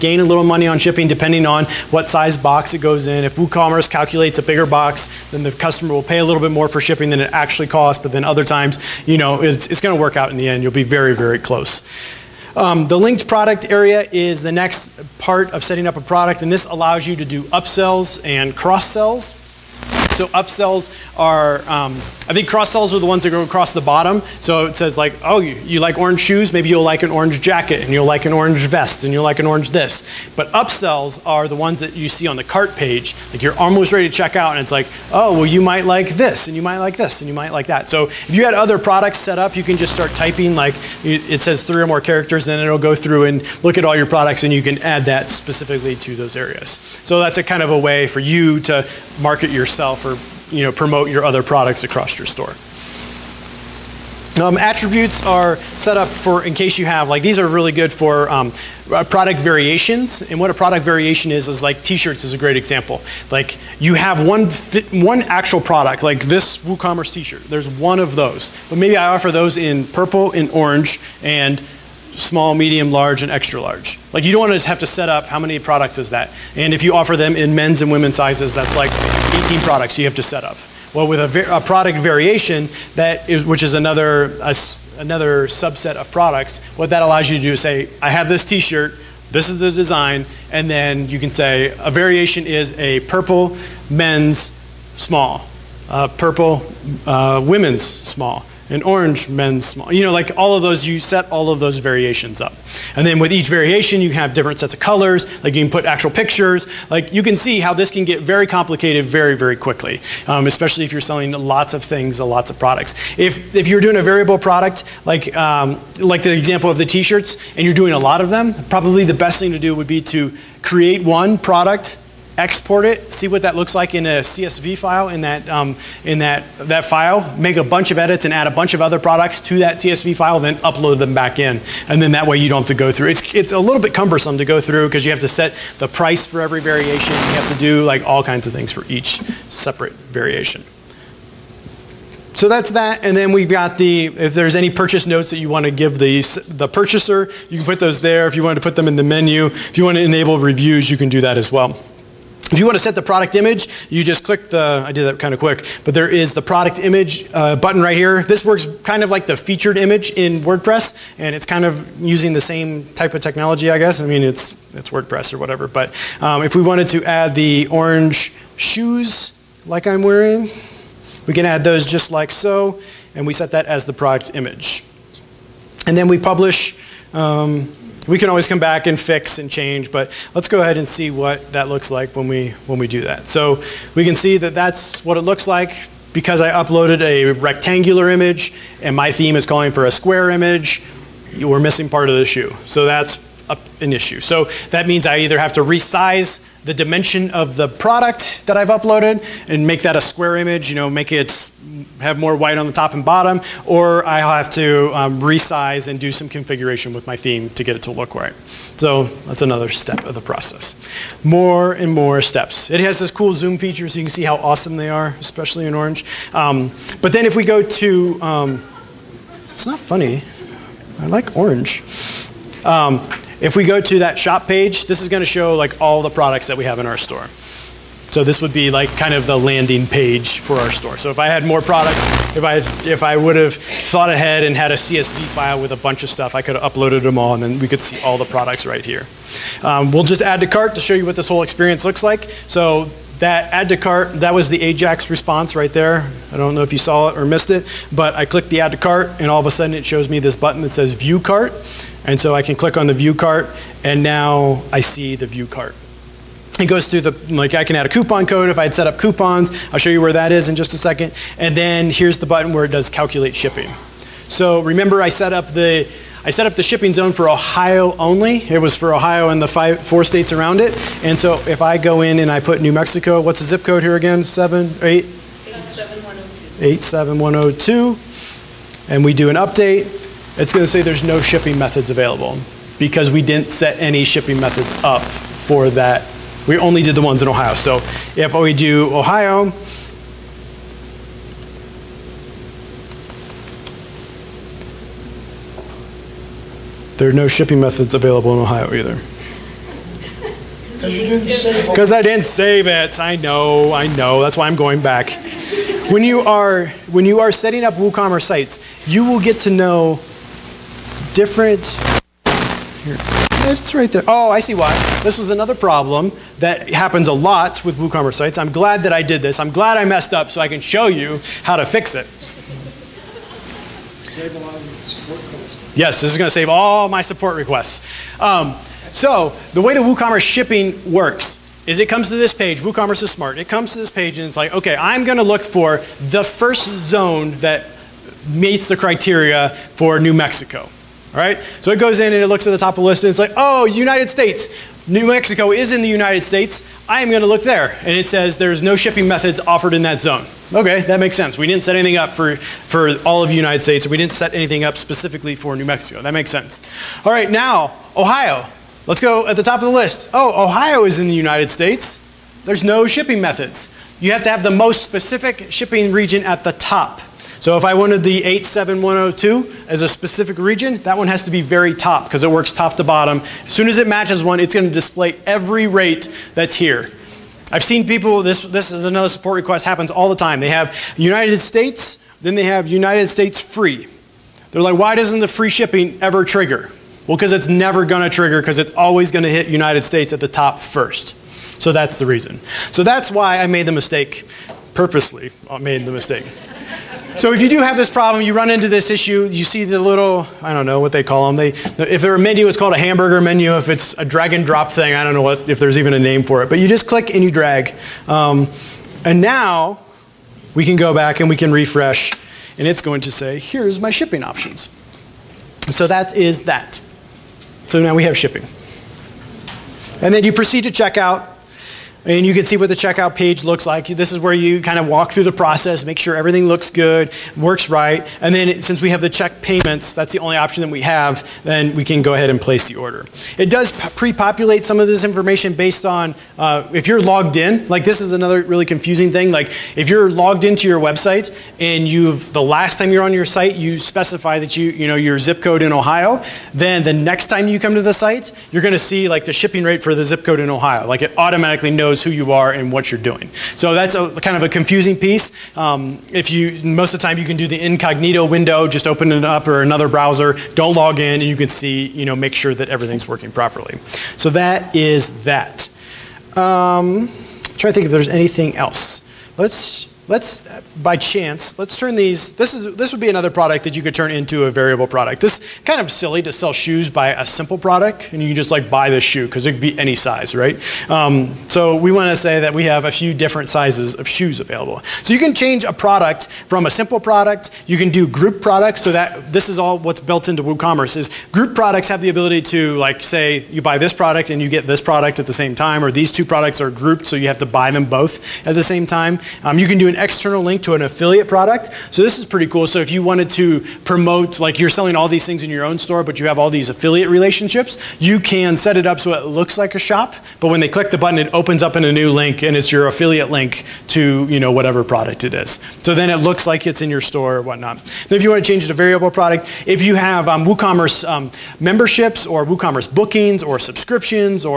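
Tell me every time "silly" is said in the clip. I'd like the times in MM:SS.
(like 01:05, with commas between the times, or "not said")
07:55.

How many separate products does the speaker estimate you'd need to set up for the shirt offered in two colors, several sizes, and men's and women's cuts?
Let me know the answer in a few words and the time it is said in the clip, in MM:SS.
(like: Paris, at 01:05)
18, at 01:19.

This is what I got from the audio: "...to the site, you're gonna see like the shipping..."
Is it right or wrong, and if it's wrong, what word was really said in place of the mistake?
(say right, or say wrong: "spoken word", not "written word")
right.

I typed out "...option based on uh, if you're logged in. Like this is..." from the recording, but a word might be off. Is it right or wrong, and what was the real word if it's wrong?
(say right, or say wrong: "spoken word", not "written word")
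wrong: "information", not "option".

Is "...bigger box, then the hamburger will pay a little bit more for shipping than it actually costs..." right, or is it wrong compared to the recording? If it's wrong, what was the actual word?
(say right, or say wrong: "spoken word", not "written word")
wrong: "customer", not "hamburger".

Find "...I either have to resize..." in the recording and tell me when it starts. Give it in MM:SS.
03:15.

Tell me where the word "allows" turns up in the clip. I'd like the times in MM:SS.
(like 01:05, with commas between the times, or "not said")
00:16, 01:27.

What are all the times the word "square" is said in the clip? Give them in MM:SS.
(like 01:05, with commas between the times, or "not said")
03:09, 03:20.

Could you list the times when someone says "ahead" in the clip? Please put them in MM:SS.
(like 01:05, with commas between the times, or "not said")
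03:00, 03:54, 07:12.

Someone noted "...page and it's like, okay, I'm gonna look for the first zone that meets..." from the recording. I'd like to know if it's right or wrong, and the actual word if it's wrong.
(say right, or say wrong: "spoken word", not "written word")
right.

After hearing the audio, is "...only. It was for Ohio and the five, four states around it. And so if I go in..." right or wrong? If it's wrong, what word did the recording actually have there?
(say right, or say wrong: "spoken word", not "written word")
right.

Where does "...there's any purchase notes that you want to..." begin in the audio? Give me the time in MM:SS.
02:24.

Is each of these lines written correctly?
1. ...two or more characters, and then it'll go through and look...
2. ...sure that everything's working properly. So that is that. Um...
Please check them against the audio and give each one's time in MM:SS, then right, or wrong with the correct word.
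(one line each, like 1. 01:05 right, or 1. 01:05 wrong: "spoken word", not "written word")
1. 00:41 wrong: "three", not "two"
2. 07:42 right.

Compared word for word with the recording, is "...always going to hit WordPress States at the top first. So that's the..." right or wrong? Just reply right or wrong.
wrong.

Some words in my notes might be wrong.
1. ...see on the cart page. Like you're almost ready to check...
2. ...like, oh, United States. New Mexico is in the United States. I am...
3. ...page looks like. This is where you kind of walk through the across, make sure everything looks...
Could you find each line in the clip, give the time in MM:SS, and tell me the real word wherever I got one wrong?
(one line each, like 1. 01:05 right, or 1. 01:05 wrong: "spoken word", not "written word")
1. 00:32 right
2. 05:43 right
3. 07:03 wrong: "process", not "across".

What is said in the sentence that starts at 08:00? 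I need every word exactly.
Um, so we want to say that we have a few different sizes of shoes available.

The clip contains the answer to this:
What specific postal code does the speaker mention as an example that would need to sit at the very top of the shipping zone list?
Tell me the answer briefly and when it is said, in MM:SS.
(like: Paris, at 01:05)
87102, at 06:08.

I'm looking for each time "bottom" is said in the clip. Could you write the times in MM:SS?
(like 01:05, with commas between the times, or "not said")
00:23, 03:23, 06:12.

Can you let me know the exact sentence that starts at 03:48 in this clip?
So this would be like kind of the landing page for our store.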